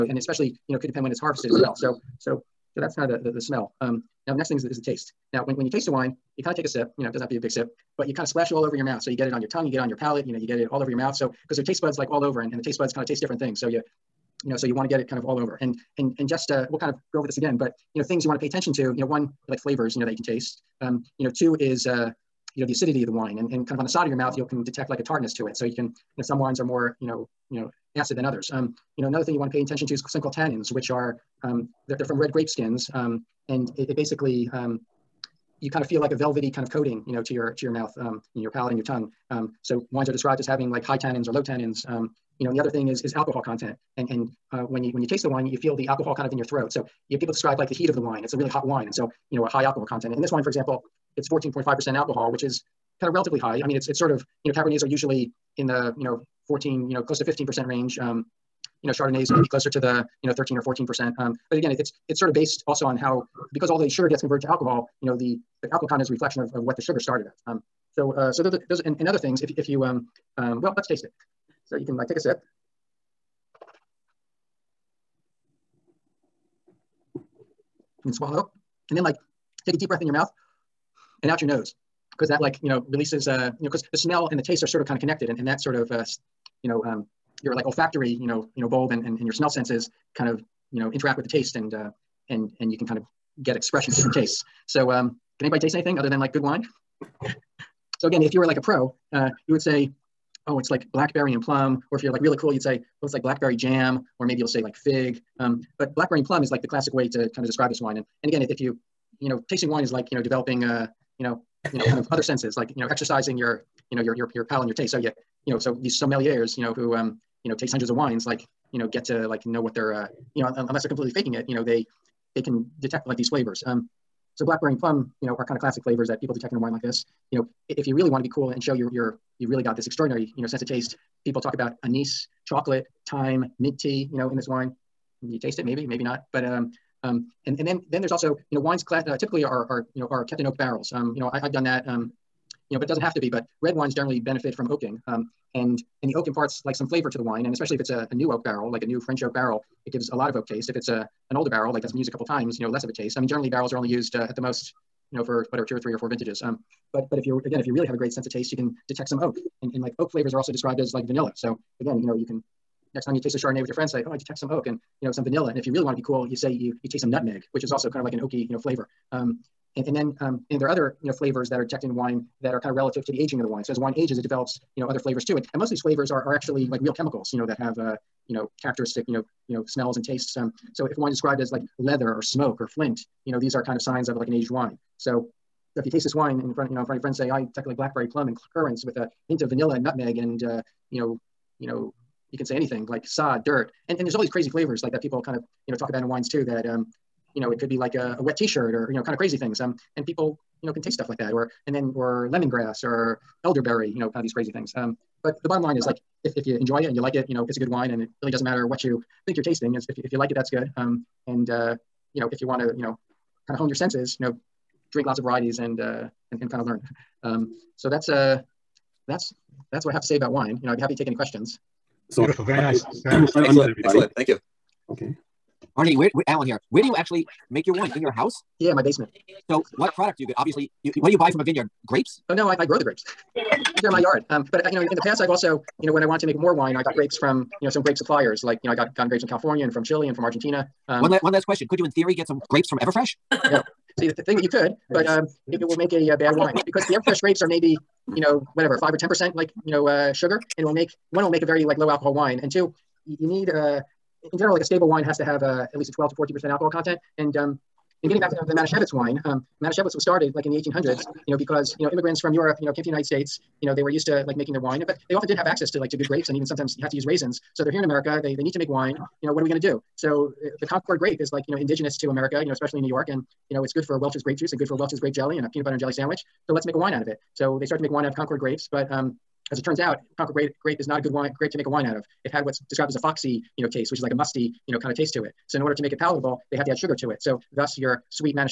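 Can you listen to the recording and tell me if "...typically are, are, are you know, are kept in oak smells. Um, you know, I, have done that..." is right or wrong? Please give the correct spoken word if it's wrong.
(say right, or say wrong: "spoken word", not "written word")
wrong: "barrels", not "smells".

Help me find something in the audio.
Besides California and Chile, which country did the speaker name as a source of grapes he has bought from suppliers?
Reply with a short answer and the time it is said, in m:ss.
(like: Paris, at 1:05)
Argentina, at 4:00.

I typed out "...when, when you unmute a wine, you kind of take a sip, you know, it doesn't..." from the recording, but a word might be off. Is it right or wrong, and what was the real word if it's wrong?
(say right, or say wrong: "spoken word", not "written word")
wrong: "taste", not "unmute".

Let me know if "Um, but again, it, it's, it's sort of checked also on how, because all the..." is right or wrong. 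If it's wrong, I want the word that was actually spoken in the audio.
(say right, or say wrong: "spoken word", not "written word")
wrong: "based", not "checked".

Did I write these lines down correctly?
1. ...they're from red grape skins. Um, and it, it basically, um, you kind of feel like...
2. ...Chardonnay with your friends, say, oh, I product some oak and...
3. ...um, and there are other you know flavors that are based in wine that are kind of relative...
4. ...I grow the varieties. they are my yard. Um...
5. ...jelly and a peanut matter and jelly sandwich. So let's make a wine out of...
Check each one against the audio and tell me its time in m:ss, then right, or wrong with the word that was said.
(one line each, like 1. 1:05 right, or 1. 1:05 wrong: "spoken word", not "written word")
1. 0:31 right
2. 2:43 wrong: "detect", not "product"
3. 2:50 wrong: "checked", not "based"
4. 3:52 wrong: "grapes", not "varieties"
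5. 4:35 wrong: "butter", not "matter".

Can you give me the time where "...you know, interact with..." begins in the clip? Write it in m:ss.
1:30.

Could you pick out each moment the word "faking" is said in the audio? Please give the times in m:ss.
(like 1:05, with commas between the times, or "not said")
2:01.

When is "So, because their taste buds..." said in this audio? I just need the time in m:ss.
0:11.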